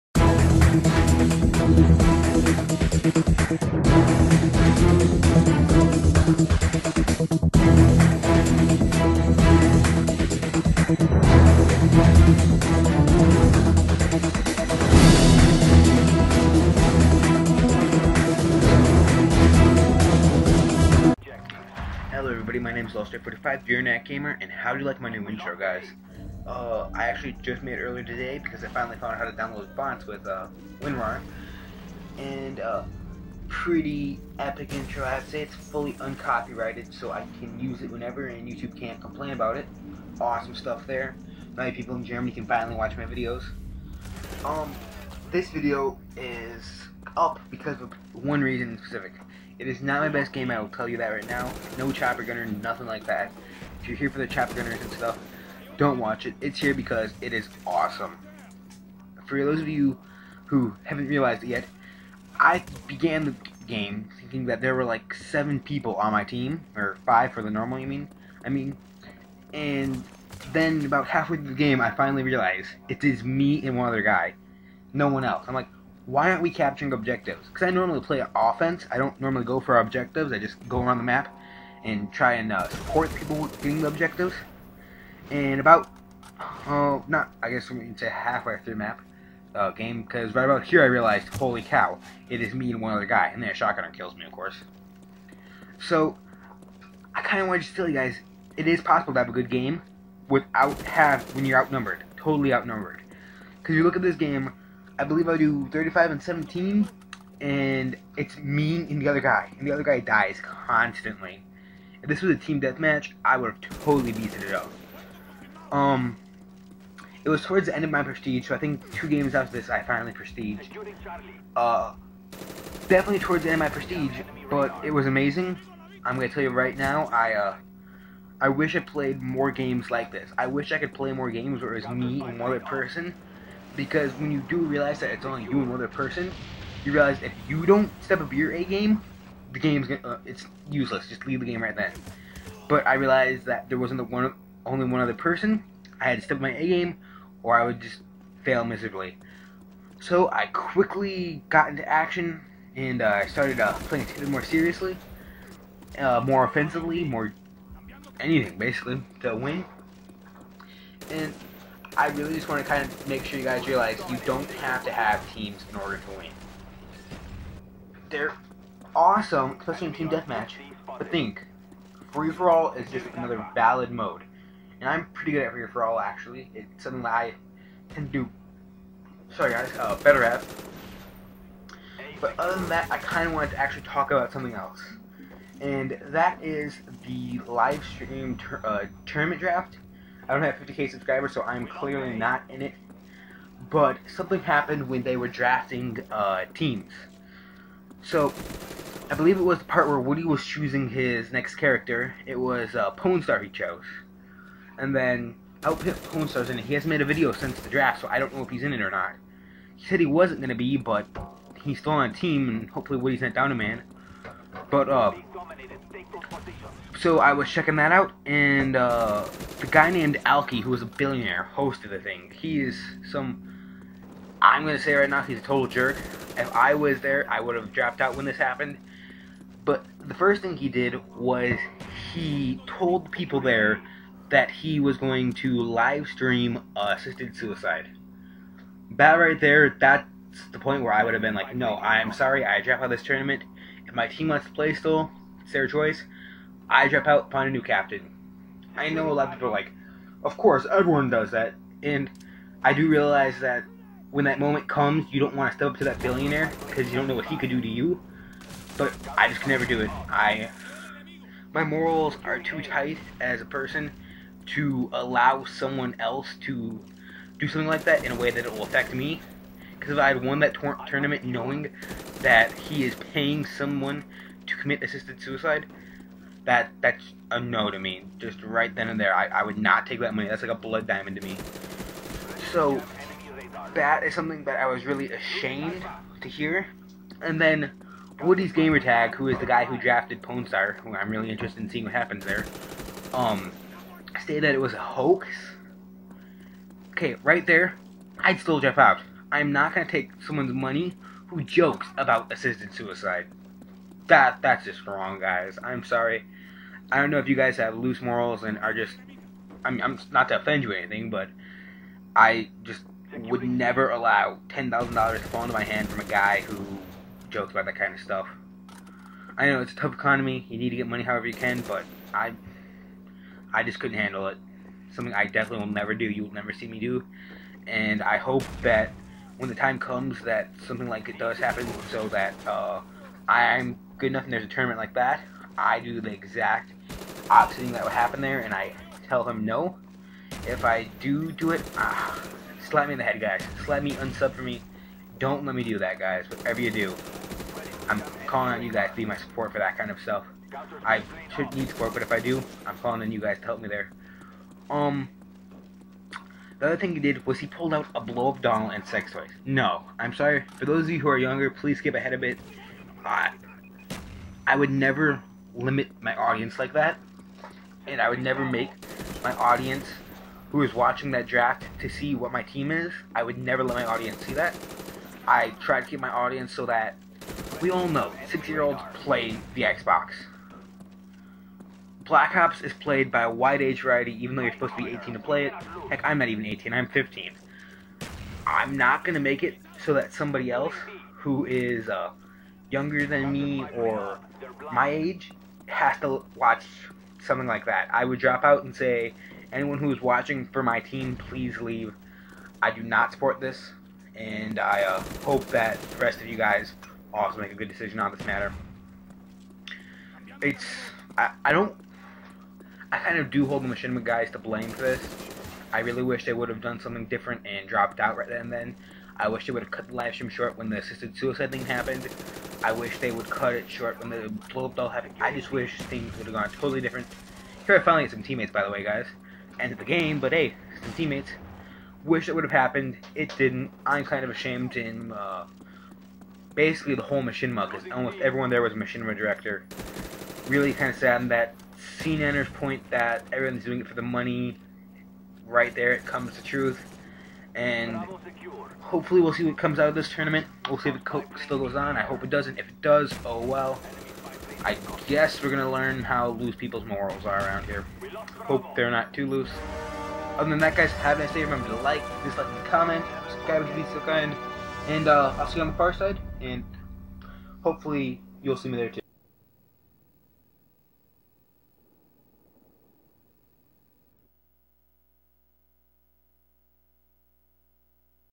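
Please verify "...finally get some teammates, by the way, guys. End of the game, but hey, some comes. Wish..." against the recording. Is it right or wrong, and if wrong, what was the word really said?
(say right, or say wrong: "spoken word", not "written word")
wrong: "teammates", not "comes".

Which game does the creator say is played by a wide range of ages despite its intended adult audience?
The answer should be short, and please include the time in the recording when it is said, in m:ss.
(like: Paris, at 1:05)
Black Ops, at 6:22.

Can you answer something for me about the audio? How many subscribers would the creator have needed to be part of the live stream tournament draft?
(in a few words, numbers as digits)
50k.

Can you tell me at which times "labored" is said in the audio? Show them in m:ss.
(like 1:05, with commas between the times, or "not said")
not said.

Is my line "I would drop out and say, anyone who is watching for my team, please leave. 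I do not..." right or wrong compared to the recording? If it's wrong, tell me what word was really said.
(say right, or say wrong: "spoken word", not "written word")
right.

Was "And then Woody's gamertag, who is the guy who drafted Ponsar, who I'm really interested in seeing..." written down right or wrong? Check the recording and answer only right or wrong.
right.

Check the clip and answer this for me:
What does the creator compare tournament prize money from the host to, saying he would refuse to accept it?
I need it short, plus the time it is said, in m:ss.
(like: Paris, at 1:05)
A blood diamond, at 4:40.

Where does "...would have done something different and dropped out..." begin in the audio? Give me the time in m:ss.
6:56.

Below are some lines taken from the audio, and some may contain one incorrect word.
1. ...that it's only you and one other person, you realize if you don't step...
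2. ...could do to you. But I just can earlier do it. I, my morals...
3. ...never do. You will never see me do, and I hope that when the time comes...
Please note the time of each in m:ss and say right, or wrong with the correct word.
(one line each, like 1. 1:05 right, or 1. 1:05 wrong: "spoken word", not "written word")
1. 2:14 right
2. 4:17 wrong: "never", not "earlier"
3. 5:25 right.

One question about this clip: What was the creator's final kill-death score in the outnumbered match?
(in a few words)
35 and 17.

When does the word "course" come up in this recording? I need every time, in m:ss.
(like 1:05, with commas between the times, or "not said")
1:34, 4:10.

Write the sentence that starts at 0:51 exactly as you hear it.
No chopper gunner, nothing like that.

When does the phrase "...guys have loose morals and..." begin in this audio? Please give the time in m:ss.
5:07.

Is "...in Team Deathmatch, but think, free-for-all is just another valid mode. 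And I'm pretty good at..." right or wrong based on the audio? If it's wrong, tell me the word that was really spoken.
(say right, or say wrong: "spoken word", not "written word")
right.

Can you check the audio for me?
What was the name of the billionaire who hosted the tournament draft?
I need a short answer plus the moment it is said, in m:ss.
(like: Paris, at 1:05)
Alki, at 3:40.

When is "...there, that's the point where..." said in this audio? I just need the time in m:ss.
3:59.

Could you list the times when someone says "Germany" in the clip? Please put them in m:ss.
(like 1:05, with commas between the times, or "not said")
0:42.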